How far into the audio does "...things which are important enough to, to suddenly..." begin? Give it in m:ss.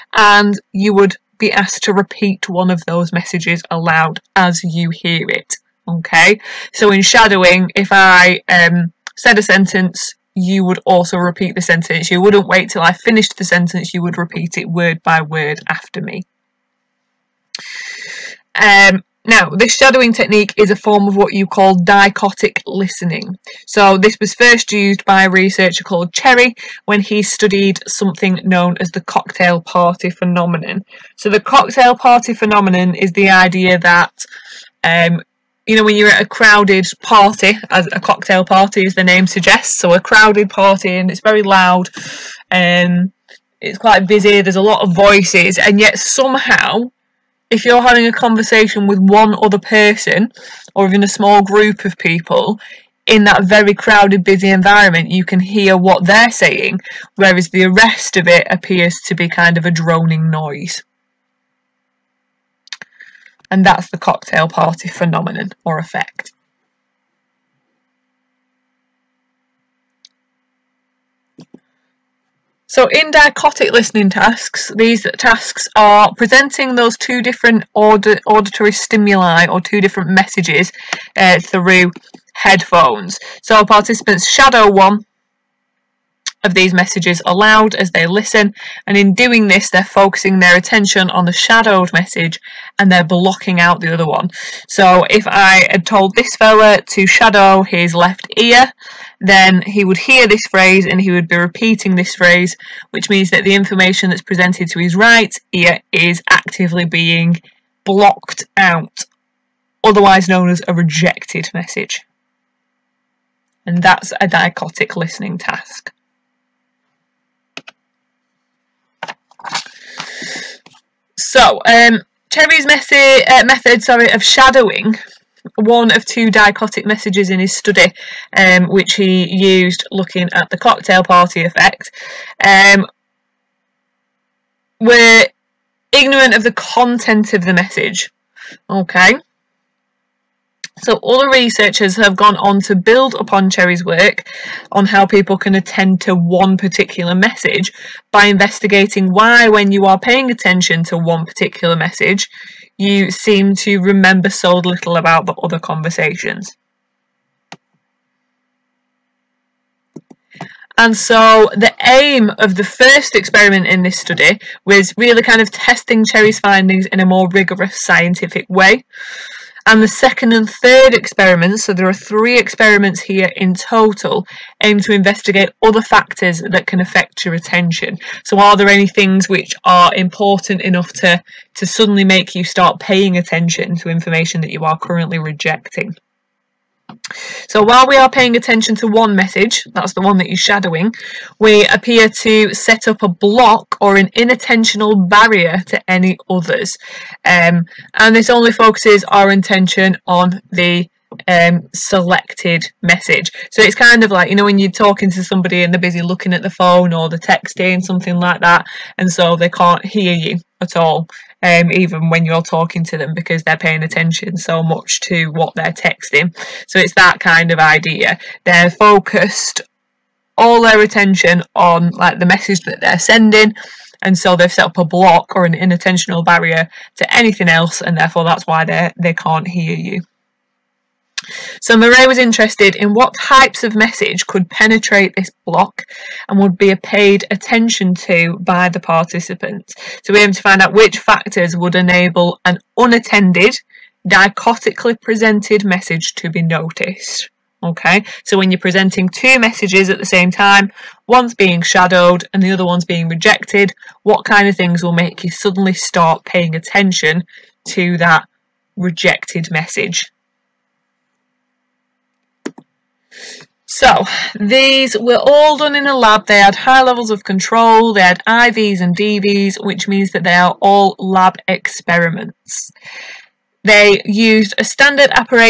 2:58.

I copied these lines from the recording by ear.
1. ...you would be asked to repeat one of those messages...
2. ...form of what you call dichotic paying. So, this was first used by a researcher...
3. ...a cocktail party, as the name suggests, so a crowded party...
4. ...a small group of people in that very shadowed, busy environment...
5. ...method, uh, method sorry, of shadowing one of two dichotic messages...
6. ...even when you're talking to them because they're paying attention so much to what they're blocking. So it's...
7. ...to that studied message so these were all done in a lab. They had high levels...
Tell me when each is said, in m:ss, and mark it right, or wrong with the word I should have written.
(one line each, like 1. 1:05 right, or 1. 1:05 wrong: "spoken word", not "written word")
1. 0:00 right
2. 0:20 wrong: "listening", not "paying"
3. 0:37 right
4. 0:51 wrong: "crowded", not "shadowed"
5. 2:02 right
6. 3:31 wrong: "texting", not "blocking"
7. 4:17 wrong: "rejected", not "studied".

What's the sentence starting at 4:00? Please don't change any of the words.
So we aim to find out which factors would enable an unattended, dichotically presented message to be noticed.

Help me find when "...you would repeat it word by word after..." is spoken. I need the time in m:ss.
0:13.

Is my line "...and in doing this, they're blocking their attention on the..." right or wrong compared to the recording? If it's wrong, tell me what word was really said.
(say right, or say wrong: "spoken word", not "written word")
wrong: "focusing", not "blocking".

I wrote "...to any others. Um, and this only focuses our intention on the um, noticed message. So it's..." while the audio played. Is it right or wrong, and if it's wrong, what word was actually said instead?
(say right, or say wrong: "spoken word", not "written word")
wrong: "selected", not "noticed".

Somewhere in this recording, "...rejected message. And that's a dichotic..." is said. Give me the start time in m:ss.
1:50.